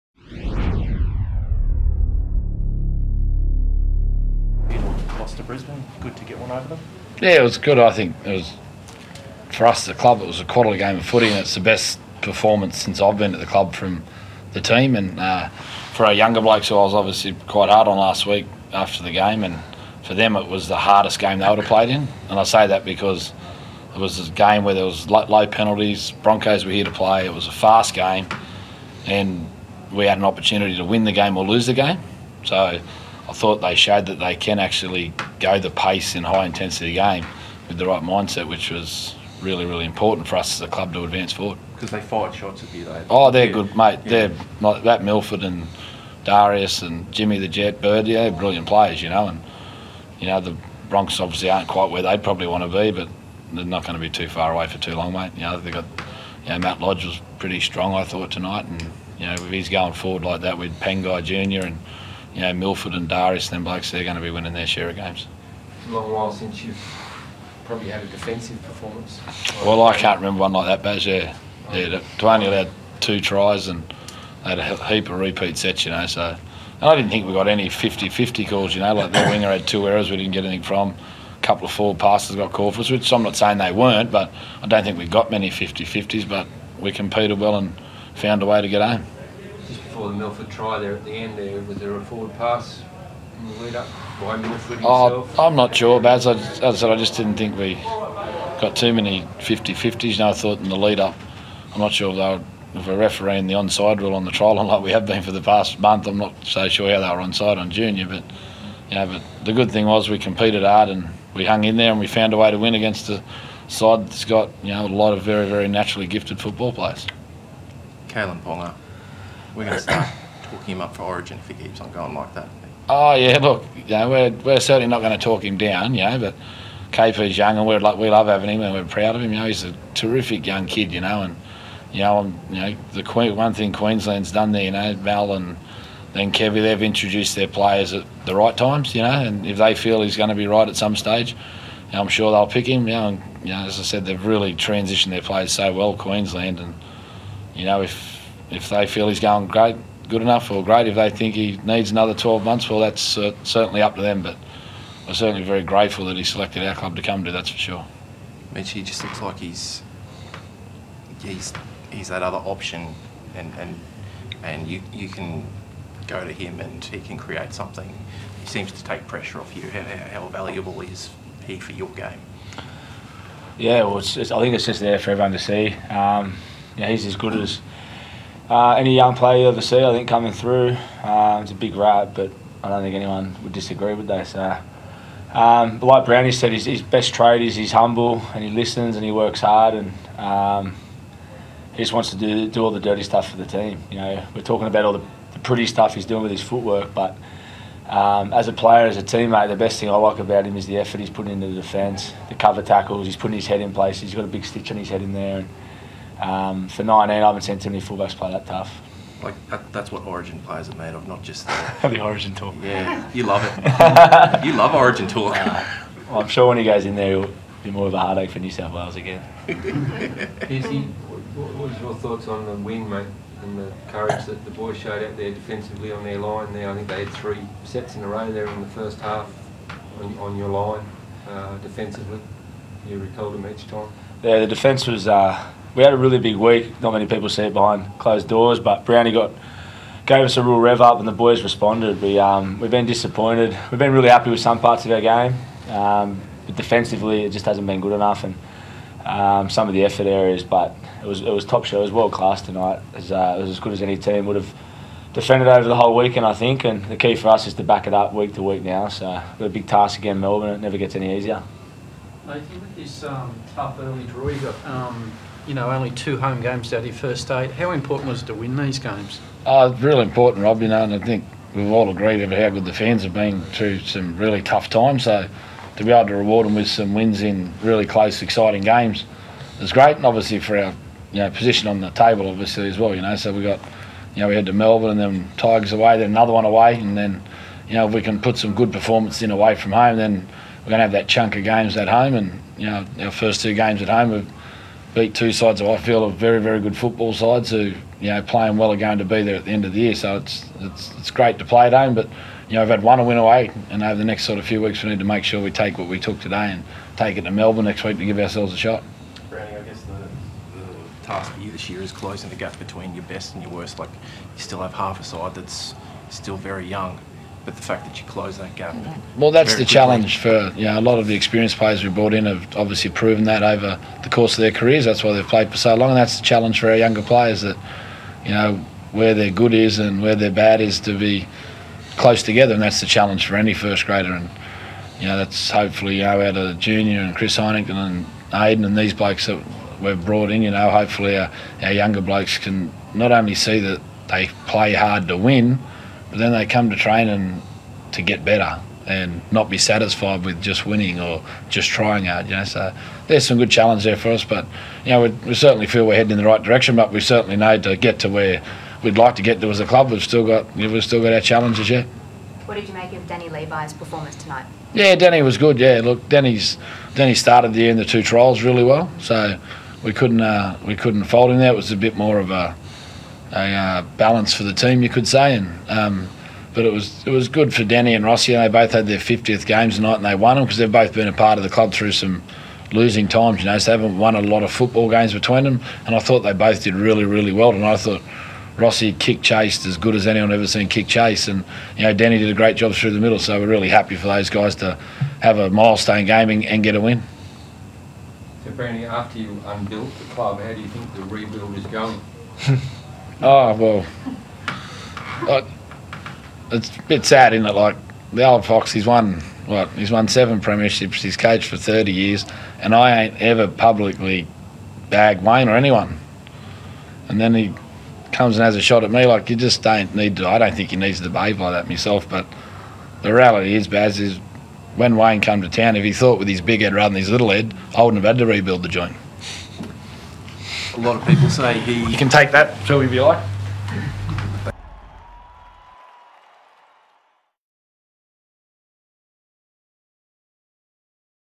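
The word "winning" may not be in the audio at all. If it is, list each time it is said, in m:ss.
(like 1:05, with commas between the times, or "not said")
1:04, 5:50.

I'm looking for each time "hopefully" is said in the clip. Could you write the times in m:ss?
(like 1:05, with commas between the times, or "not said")
5:35, 5:40.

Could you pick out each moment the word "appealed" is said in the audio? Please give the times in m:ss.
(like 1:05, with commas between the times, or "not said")
not said.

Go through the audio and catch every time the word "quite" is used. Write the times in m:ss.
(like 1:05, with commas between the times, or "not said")
0:17, 0:51.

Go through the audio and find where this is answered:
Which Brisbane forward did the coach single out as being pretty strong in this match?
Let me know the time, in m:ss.
0:56.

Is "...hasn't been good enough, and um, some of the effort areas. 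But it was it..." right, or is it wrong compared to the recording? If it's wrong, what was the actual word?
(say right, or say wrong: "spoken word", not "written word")
right.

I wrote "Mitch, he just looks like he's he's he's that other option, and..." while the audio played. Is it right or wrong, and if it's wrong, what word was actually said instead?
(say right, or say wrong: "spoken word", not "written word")
right.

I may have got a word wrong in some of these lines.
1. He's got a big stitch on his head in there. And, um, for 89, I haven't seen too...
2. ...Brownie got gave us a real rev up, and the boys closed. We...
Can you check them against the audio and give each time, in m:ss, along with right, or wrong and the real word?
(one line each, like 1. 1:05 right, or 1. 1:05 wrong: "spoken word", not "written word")
1. 3:24 wrong: "19", not "89"
2. 3:58 wrong: "responded", not "closed".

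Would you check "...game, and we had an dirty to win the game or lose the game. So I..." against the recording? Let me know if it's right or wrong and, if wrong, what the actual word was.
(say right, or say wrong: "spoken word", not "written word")
wrong: "opportunity", not "dirty".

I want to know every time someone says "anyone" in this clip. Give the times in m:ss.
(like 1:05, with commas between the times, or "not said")
3:02, 6:30, 6:55.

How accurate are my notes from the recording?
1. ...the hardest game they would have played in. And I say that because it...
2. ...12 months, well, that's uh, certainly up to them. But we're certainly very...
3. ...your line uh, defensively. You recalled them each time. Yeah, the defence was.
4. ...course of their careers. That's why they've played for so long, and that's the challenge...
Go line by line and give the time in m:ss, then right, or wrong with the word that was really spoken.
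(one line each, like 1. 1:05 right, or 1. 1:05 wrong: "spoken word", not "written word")
1. 0:20 right
2. 2:32 right
3. 3:50 right
4. 5:24 right.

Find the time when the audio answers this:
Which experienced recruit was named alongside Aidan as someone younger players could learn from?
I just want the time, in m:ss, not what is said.
5:37.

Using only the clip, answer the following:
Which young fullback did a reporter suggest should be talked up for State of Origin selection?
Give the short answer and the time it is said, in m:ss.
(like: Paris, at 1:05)
Kalyn Ponga, at 1:58.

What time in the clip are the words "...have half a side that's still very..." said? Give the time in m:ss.
5:14.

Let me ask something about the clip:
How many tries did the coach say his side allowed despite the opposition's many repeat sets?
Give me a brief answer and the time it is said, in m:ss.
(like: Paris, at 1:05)
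2, at 1:12.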